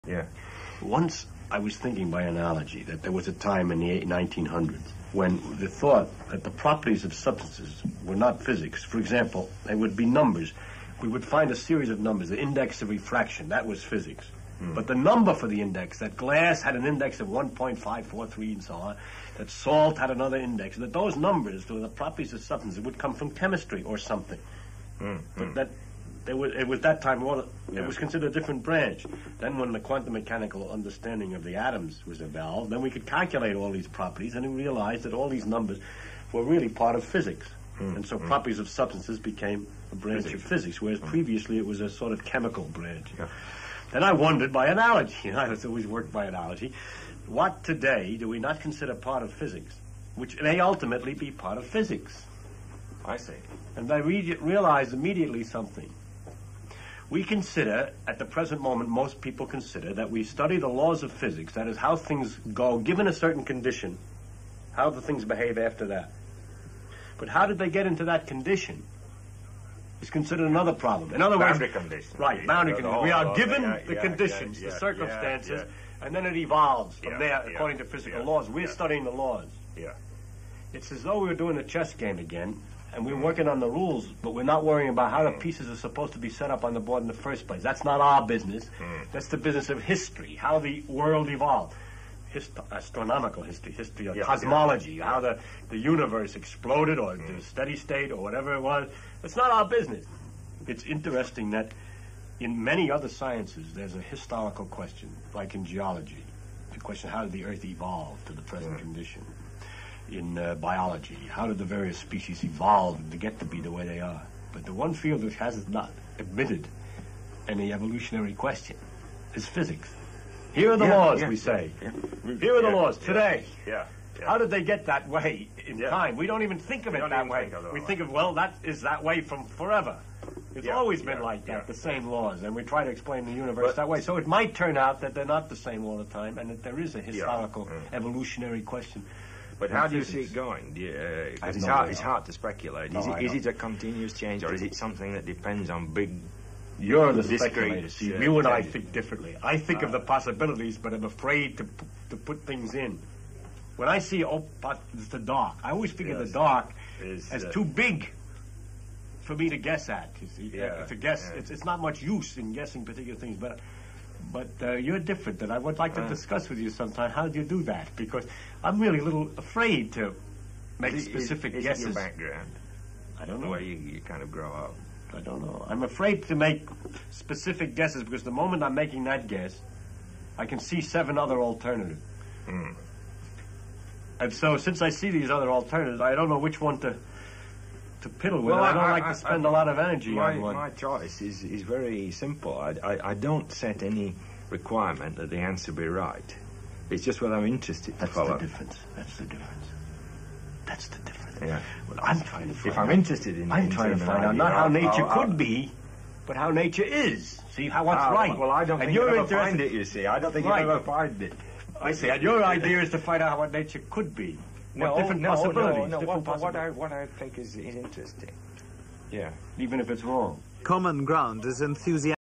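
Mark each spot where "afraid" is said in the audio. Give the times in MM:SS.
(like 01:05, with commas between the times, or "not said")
02:31, 02:49, 02:55.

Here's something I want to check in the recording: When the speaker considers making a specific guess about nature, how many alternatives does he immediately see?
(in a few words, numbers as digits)
7.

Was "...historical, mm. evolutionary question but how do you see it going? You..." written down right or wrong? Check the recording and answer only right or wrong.
right.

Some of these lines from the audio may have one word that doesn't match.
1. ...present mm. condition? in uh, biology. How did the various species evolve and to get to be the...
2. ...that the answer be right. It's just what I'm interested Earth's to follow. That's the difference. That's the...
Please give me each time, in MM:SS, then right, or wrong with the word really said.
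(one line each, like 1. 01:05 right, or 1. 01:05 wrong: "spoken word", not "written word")
1. 01:48 right
2. 03:15 wrong: "That", not "Earth".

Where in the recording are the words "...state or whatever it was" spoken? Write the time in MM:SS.
01:37.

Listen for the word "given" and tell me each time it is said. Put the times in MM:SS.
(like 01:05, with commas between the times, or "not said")
01:02, 01:13.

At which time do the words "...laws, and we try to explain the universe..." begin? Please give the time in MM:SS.
02:12.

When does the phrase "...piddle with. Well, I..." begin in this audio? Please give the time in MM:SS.
03:08.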